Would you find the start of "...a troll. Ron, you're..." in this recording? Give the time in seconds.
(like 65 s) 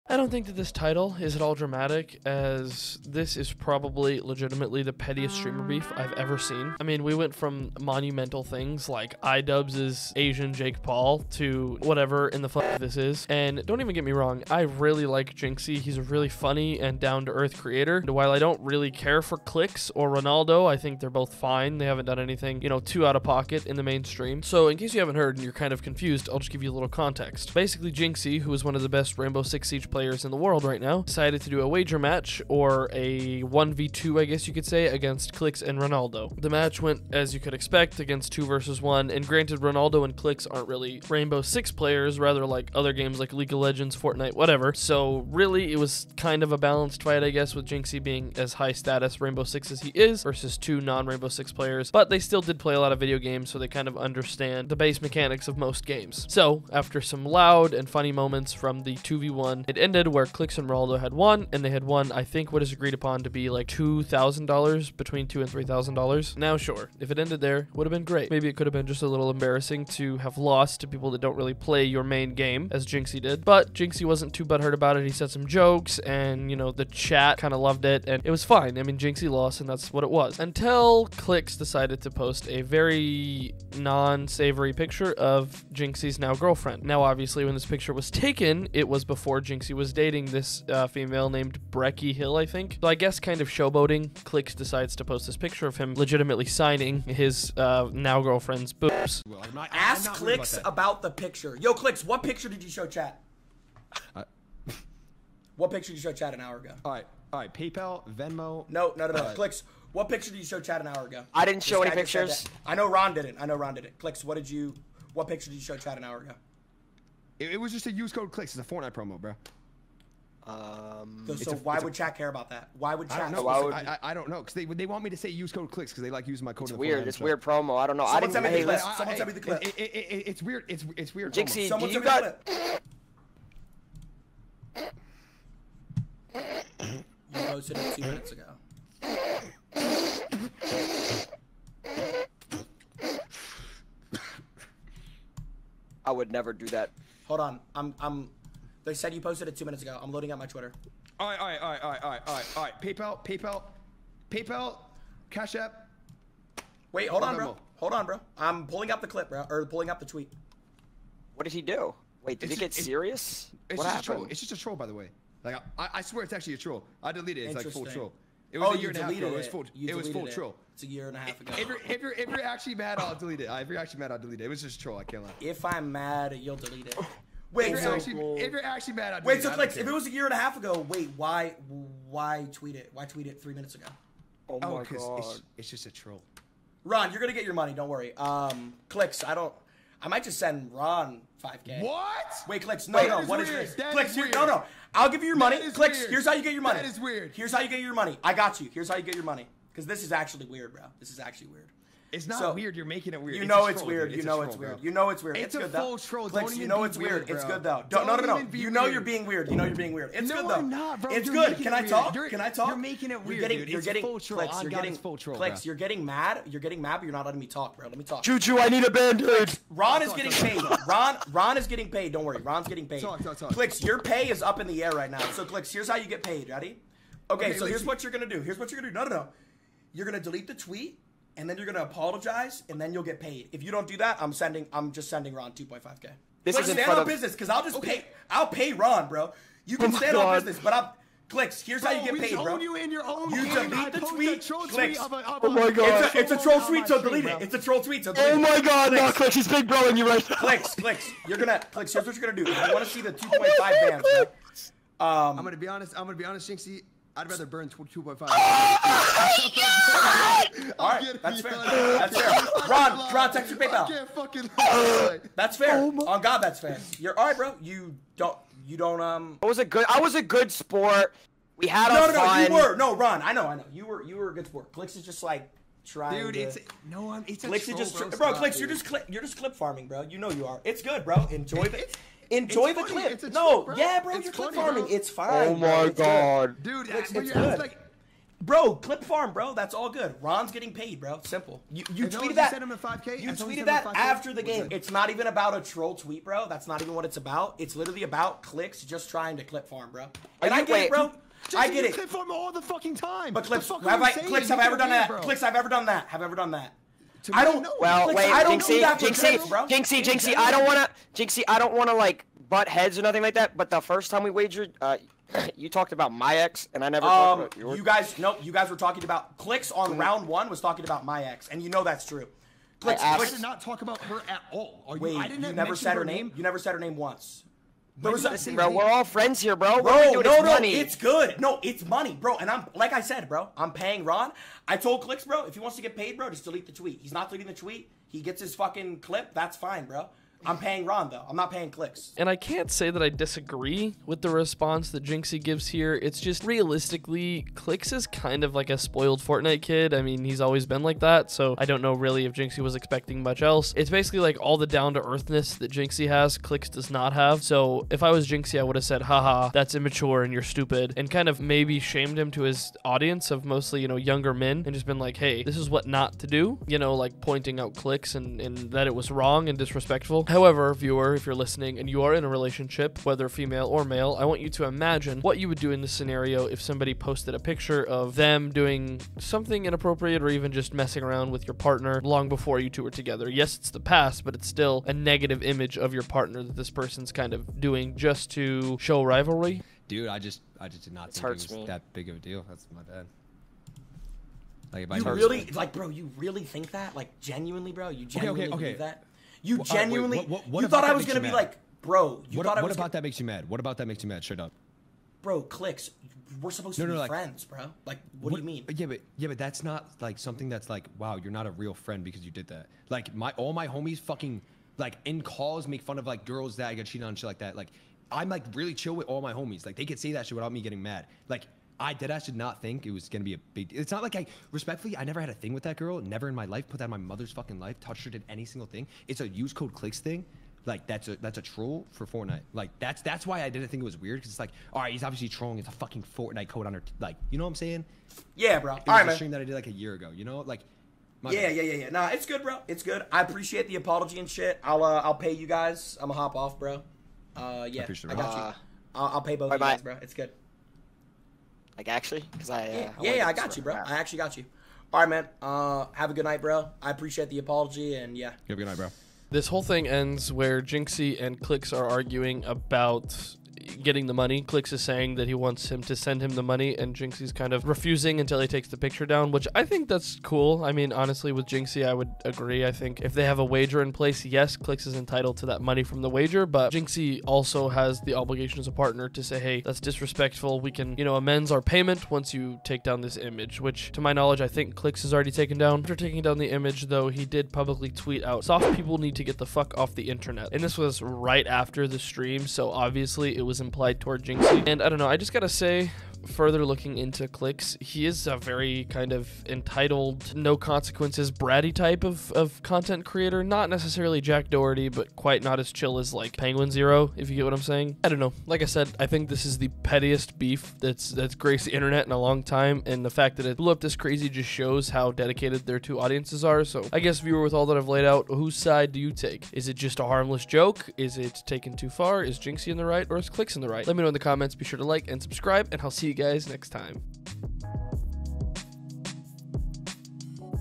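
185 s.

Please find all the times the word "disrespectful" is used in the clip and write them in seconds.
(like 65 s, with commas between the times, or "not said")
369 s, 479 s.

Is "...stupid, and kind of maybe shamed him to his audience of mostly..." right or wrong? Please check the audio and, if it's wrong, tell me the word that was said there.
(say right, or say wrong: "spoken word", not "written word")
right.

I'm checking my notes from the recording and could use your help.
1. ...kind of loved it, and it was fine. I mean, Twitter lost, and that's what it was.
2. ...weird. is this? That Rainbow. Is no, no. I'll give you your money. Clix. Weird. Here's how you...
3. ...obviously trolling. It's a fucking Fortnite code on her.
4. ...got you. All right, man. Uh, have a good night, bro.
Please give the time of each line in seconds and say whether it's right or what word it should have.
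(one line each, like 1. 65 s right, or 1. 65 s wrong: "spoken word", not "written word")
1. 77 s wrong: "Jynxzi", not "Twitter"
2. 193 s wrong: "Clix", not "Rainbow"
3. 435 s right
4. 454 s right.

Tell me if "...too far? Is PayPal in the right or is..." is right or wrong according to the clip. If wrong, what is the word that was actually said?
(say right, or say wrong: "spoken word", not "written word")
wrong: "Jynxzi", not "PayPal".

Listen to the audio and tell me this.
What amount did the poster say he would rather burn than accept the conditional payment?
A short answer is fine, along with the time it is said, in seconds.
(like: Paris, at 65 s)
22.5, at 257 s.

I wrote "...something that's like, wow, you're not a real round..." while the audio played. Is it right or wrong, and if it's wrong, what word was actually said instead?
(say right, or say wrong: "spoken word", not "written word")
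wrong: "friend", not "round".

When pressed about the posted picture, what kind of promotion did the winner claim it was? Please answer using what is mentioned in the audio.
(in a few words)
Fortnite promo.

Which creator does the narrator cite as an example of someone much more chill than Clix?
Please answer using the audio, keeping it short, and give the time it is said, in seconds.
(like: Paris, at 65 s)
Penguin Zero, at 506 s.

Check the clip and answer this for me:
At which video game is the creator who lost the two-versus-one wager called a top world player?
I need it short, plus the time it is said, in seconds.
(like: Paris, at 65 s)
Rainbow Six Siege, at 29 s.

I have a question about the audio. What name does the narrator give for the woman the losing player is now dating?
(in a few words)
Breckie Hill.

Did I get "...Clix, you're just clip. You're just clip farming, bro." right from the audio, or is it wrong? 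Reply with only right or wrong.
right.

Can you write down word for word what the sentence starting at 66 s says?
Now, sure, if it ended there, would have been great.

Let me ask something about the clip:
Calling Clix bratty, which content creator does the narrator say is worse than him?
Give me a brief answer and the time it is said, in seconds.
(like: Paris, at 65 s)
Jack Doherty, at 504 s.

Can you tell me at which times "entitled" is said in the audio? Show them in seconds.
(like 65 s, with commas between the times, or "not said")
474 s, 499 s.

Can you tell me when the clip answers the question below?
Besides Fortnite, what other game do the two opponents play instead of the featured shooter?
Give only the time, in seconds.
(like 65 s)
43 s.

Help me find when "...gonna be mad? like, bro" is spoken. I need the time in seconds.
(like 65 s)
401 s.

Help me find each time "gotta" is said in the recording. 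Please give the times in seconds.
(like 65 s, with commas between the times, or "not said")
495 s.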